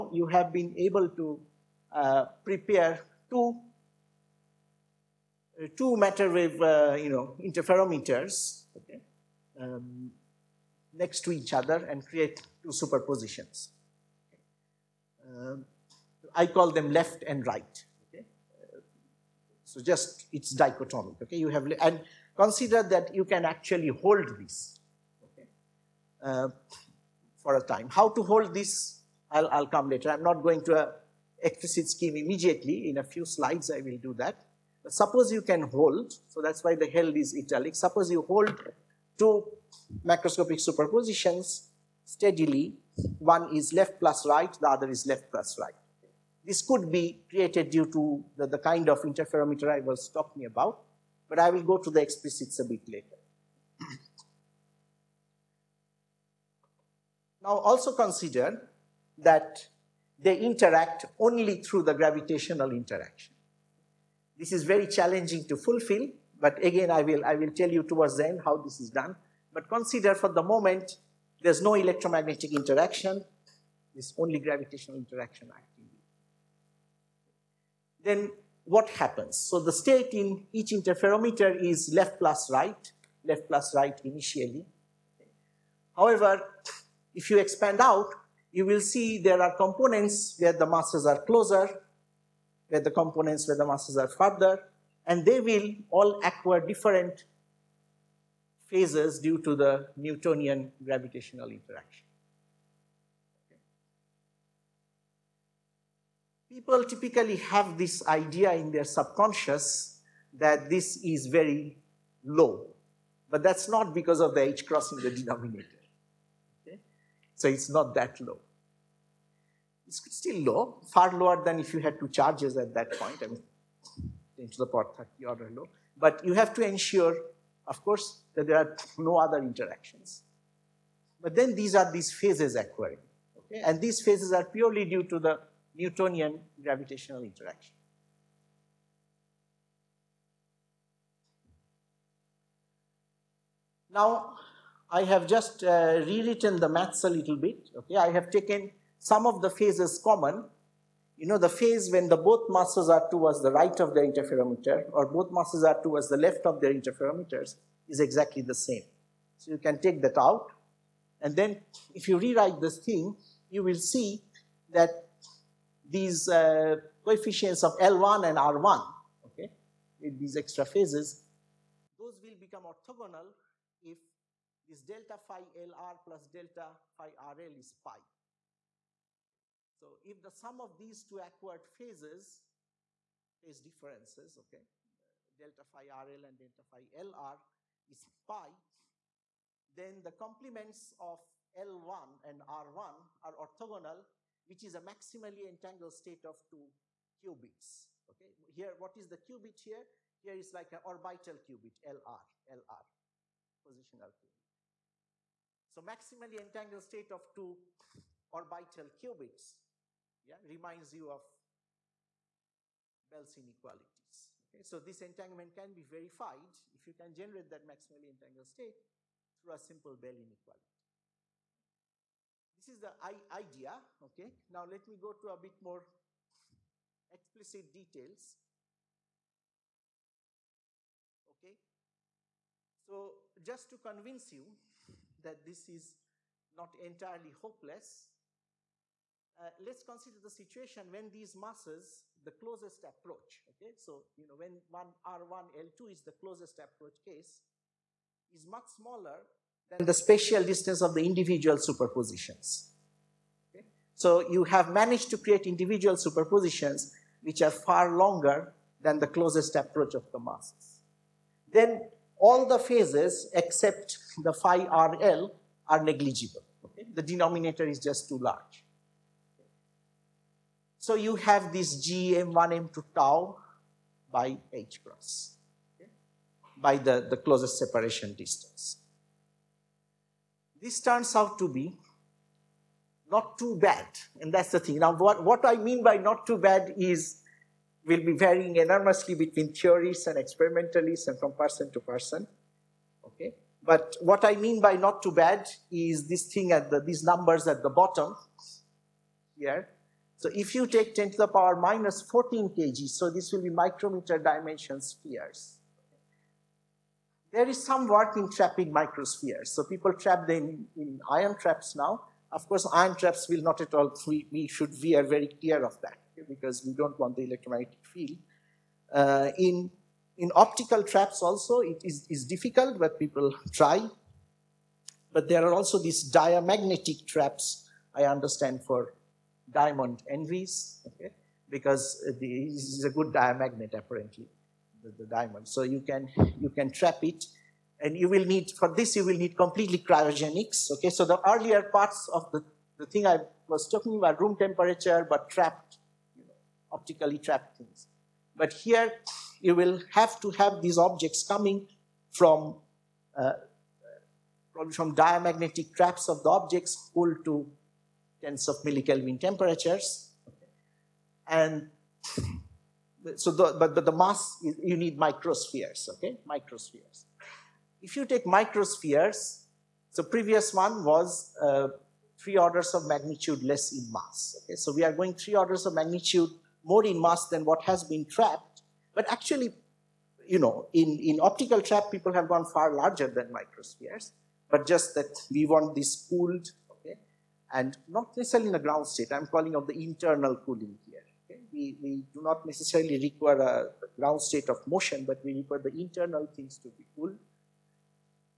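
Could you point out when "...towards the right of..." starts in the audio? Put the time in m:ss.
2:33.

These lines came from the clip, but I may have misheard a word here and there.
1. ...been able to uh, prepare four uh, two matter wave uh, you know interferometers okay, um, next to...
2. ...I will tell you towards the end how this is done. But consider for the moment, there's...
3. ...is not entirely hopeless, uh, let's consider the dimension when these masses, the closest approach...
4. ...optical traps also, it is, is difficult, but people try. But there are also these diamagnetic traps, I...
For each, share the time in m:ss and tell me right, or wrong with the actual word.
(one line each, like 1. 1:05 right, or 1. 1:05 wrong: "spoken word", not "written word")
1. 0:00 wrong: "two", not "four"
2. 1:07 right
3. 3:55 wrong: "situation", not "dimension"
4. 5:20 right.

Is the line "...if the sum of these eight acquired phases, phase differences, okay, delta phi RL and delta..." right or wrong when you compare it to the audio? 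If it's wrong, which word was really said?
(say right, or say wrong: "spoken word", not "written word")
wrong: "two", not "eight".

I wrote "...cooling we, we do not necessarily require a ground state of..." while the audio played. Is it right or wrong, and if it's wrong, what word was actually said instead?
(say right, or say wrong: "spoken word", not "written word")
right.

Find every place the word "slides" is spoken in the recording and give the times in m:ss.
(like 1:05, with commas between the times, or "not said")
0:33.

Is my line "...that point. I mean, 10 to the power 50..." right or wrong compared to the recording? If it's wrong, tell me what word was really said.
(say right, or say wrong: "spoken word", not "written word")
wrong: "30", not "50".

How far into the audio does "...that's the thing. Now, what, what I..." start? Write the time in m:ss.
4:44.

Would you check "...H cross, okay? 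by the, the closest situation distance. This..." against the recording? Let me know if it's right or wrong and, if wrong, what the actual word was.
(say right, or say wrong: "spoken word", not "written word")
wrong: "separation", not "situation".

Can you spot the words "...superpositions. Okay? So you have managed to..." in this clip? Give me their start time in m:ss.
4:11.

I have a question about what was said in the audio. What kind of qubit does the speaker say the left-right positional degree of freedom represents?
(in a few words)
Orbital qubit.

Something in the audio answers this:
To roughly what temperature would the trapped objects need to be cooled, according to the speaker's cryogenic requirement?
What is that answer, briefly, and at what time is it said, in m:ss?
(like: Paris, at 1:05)
Tens of millikelvin, at 5:58.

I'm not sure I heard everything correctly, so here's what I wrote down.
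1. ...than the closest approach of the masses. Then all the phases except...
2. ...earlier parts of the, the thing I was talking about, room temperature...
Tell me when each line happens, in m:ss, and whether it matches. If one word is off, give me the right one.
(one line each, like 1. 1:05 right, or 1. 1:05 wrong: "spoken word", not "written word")
1. 4:18 right
2. 5:41 right.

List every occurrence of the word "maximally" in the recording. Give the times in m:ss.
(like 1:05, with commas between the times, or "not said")
3:14, 3:25, 3:37.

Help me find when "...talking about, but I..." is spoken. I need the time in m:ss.
0:50.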